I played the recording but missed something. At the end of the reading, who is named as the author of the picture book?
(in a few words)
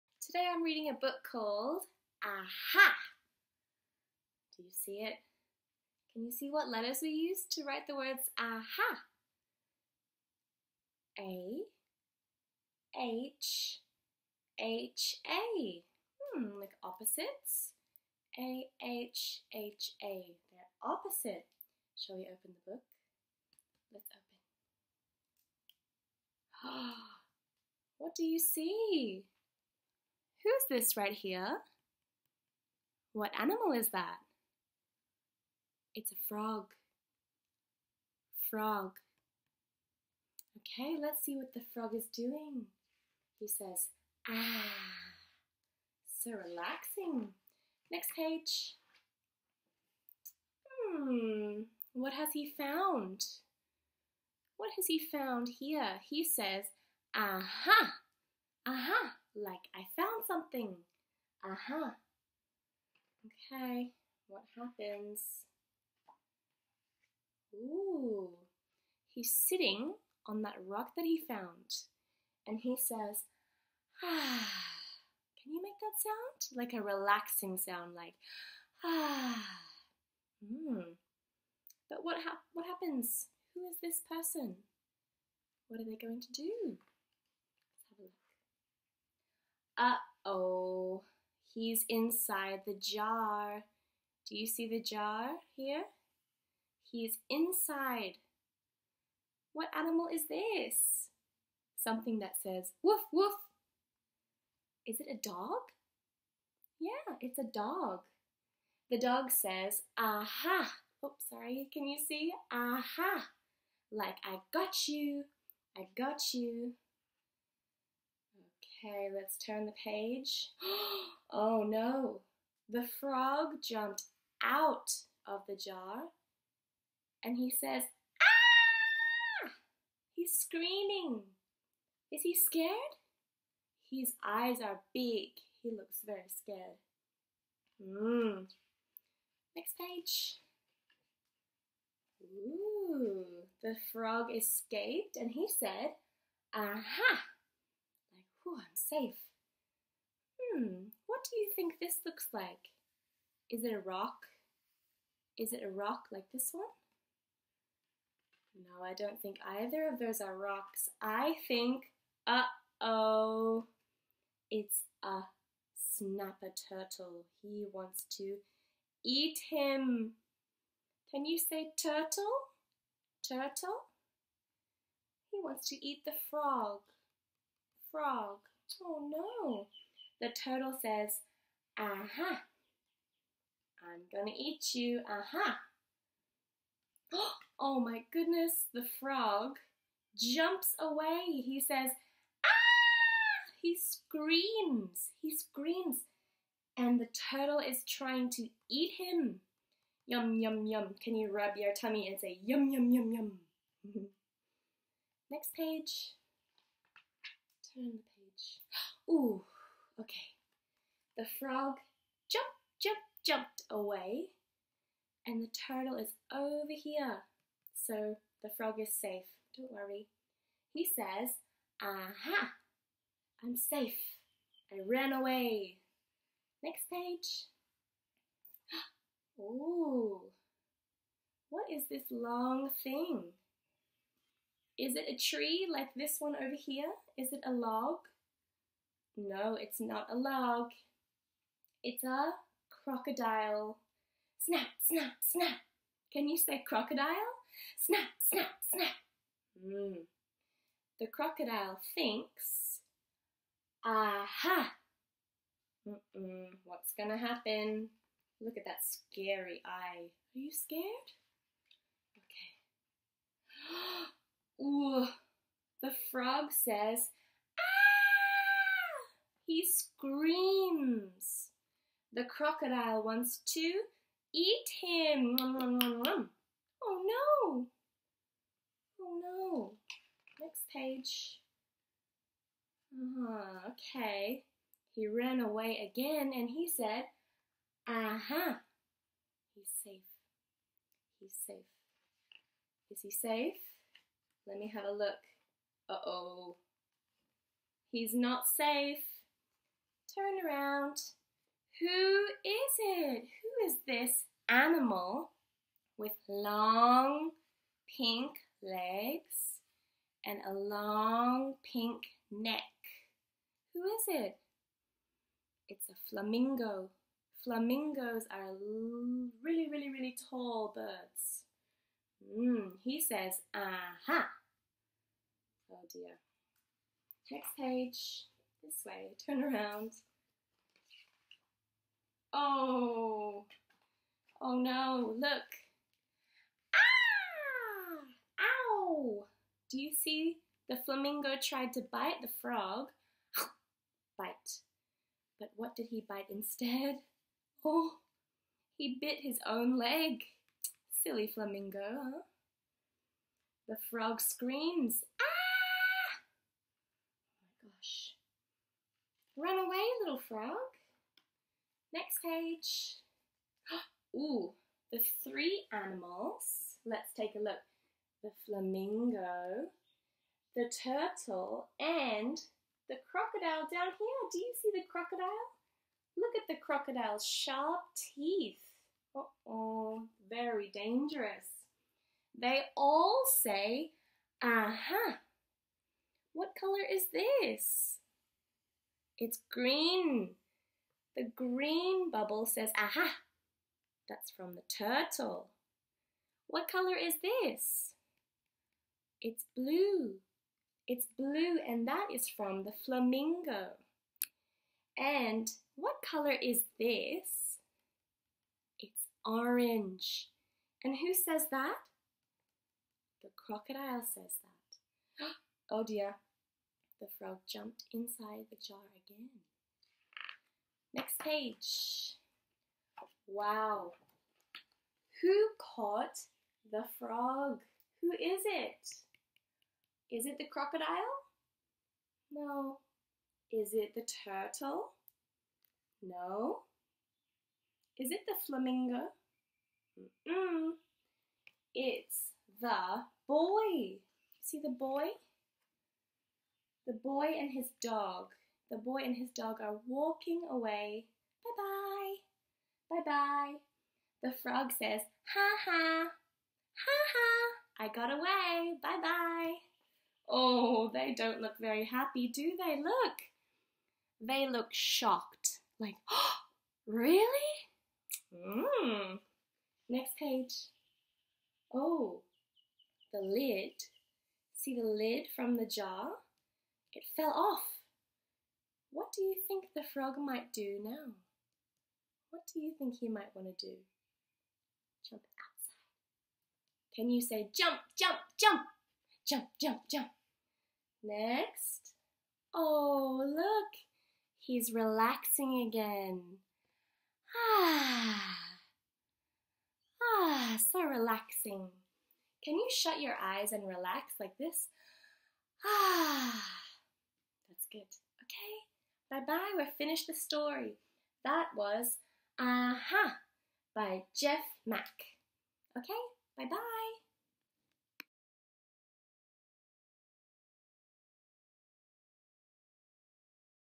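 Jeff Mack.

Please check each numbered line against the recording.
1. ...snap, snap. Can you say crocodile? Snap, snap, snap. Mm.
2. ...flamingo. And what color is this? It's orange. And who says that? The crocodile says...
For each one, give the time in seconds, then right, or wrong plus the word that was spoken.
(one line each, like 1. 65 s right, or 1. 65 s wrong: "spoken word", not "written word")
1. 244 s right
2. 402 s right.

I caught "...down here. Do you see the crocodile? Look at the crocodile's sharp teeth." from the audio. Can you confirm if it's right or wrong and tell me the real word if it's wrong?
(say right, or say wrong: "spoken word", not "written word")
right.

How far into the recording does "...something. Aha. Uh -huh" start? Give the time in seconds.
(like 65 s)
60 s.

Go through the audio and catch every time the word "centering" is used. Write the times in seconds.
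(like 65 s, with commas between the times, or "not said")
not said.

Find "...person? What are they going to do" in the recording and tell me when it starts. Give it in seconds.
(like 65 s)
84 s.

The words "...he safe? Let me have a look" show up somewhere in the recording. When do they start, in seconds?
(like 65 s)
293 s.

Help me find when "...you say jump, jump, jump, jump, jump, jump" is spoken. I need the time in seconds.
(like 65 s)
487 s.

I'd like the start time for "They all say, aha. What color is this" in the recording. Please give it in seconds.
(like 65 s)
382 s.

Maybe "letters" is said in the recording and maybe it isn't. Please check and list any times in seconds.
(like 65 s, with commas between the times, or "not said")
6 s.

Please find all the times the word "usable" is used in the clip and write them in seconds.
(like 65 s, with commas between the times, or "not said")
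not said.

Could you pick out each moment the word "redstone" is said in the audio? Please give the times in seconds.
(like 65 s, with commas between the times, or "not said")
not said.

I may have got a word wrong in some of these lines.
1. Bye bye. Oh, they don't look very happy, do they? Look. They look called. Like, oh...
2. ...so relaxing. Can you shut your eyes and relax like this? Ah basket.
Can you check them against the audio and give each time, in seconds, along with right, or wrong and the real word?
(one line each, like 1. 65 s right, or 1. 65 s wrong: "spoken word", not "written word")
1. 458 s wrong: "shocked", not "called"
2. 500 s right.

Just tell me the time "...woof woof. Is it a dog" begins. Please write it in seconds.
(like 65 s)
102 s.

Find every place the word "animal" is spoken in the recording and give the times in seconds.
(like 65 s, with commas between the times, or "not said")
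33 s, 99 s, 304 s, 365 s.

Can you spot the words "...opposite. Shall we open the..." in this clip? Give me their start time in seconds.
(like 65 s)
20 s.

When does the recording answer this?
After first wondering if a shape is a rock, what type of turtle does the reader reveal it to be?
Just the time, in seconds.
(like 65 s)
165 s.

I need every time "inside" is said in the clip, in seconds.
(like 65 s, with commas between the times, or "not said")
91 s, 97 s, 417 s.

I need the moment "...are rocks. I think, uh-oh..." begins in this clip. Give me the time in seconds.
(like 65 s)
160 s.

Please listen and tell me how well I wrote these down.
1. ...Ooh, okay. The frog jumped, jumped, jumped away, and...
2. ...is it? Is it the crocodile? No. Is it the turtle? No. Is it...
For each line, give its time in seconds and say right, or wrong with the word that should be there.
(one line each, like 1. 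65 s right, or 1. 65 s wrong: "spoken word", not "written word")
1. 209 s right
2. 428 s right.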